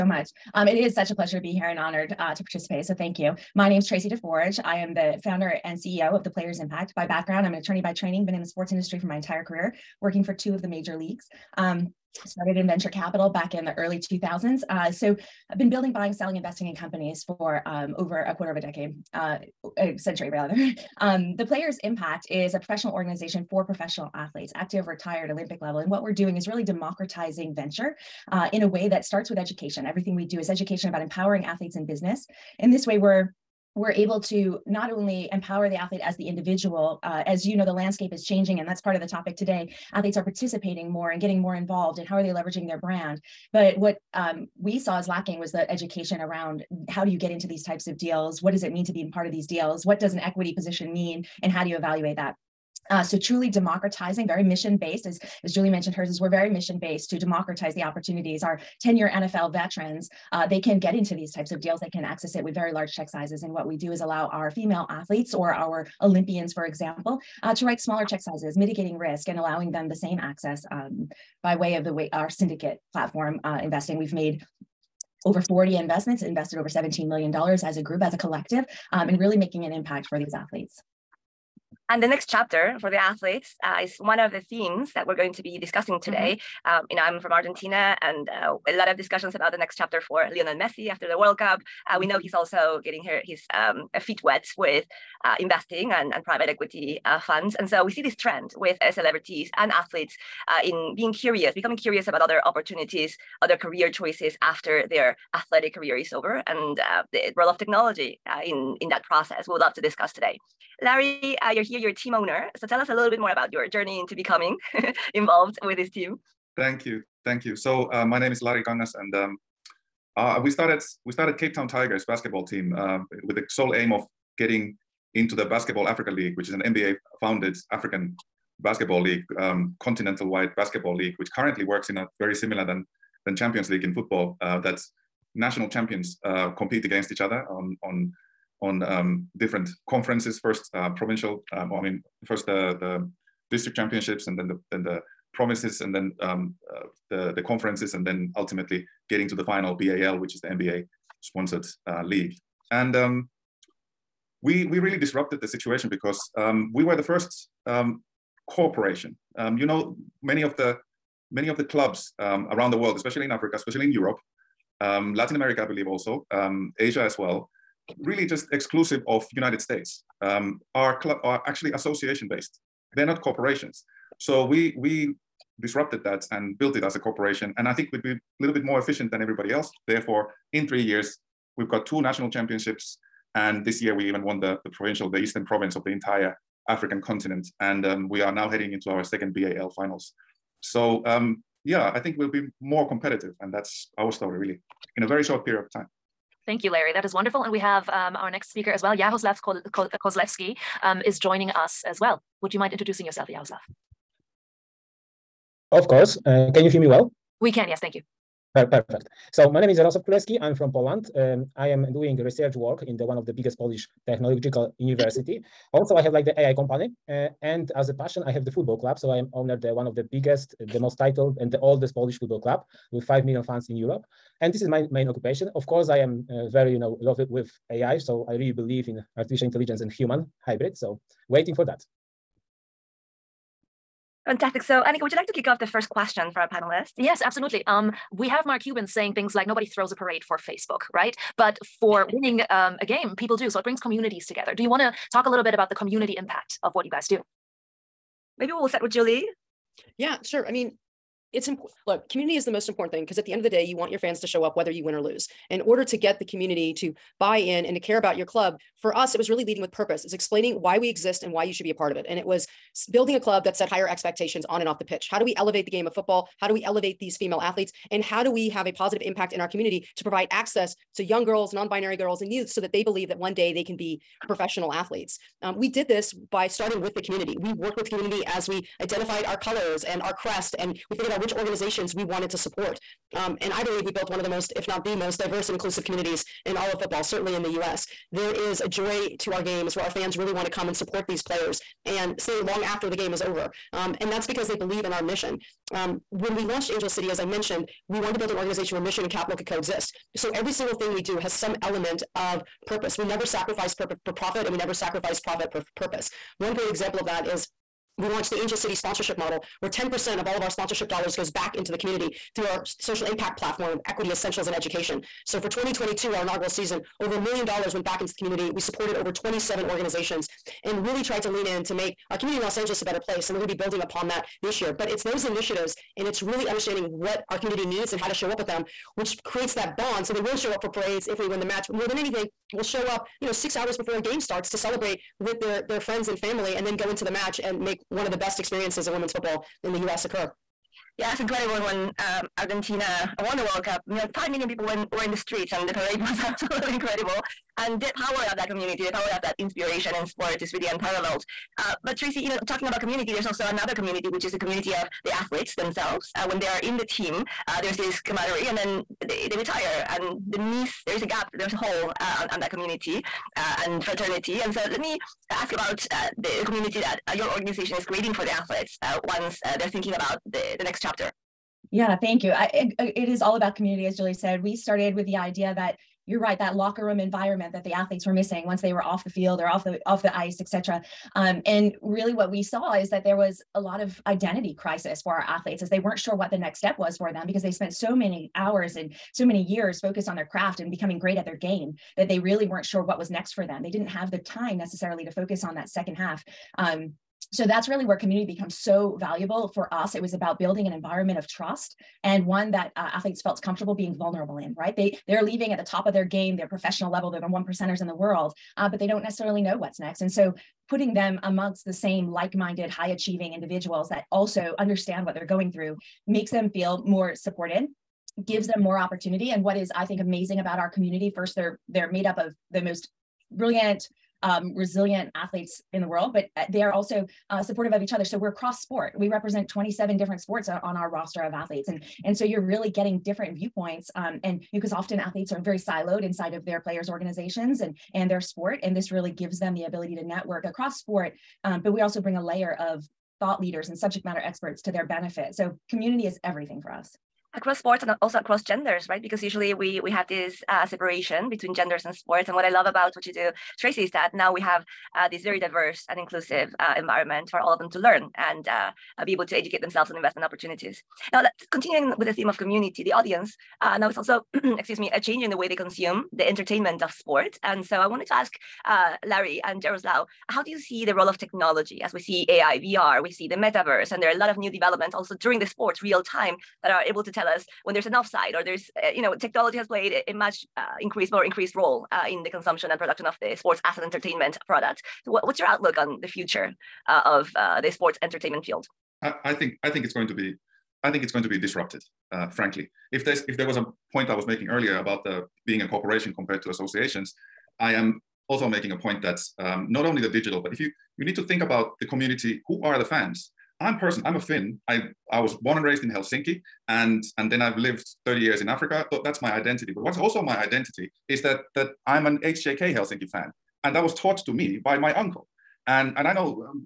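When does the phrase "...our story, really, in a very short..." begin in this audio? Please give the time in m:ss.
3:13.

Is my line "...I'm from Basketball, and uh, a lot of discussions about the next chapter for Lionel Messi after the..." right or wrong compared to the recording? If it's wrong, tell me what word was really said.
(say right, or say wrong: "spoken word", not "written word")
wrong: "Argentina", not "Basketball".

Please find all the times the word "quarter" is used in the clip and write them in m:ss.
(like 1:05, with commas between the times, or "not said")
0:18.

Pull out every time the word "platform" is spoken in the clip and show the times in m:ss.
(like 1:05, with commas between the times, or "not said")
1:12, 5:13.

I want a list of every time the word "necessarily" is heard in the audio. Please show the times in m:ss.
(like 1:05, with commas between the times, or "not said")
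6:34, 6:49.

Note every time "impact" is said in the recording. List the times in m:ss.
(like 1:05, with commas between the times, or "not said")
0:06, 0:21, 1:19, 4:06, 4:29, 5:13.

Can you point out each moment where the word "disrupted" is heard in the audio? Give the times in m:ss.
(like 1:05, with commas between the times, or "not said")
2:34, 2:55, 8:11.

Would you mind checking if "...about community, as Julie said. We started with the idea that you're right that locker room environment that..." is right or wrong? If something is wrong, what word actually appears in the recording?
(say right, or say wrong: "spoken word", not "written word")
right.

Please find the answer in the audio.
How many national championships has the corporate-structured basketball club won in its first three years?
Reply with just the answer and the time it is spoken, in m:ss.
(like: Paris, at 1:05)
2, at 3:01.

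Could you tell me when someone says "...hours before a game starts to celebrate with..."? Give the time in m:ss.
5:33.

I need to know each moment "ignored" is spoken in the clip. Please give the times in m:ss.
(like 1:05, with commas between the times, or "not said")
not said.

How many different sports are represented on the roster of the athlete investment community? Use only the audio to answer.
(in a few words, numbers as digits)
27.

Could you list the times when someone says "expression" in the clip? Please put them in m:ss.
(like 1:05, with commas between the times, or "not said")
not said.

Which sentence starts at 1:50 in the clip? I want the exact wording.
Larry, uh, you're here, you're a team owner.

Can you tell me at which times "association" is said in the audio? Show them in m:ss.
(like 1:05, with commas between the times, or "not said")
2:51, 8:16.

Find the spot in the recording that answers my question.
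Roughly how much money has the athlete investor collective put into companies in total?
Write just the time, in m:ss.
1:16.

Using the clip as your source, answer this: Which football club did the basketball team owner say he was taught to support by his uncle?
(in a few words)
HJK Helsinki.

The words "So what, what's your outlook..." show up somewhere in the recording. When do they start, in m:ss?
8:05.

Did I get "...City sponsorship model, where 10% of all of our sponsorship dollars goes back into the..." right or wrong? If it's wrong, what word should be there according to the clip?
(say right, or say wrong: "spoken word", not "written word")
right.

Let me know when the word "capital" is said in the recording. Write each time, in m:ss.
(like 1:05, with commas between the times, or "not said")
0:12, 4:59.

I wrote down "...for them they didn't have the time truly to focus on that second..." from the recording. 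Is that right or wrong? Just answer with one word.
wrong.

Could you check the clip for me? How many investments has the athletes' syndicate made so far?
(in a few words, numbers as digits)
Over 40.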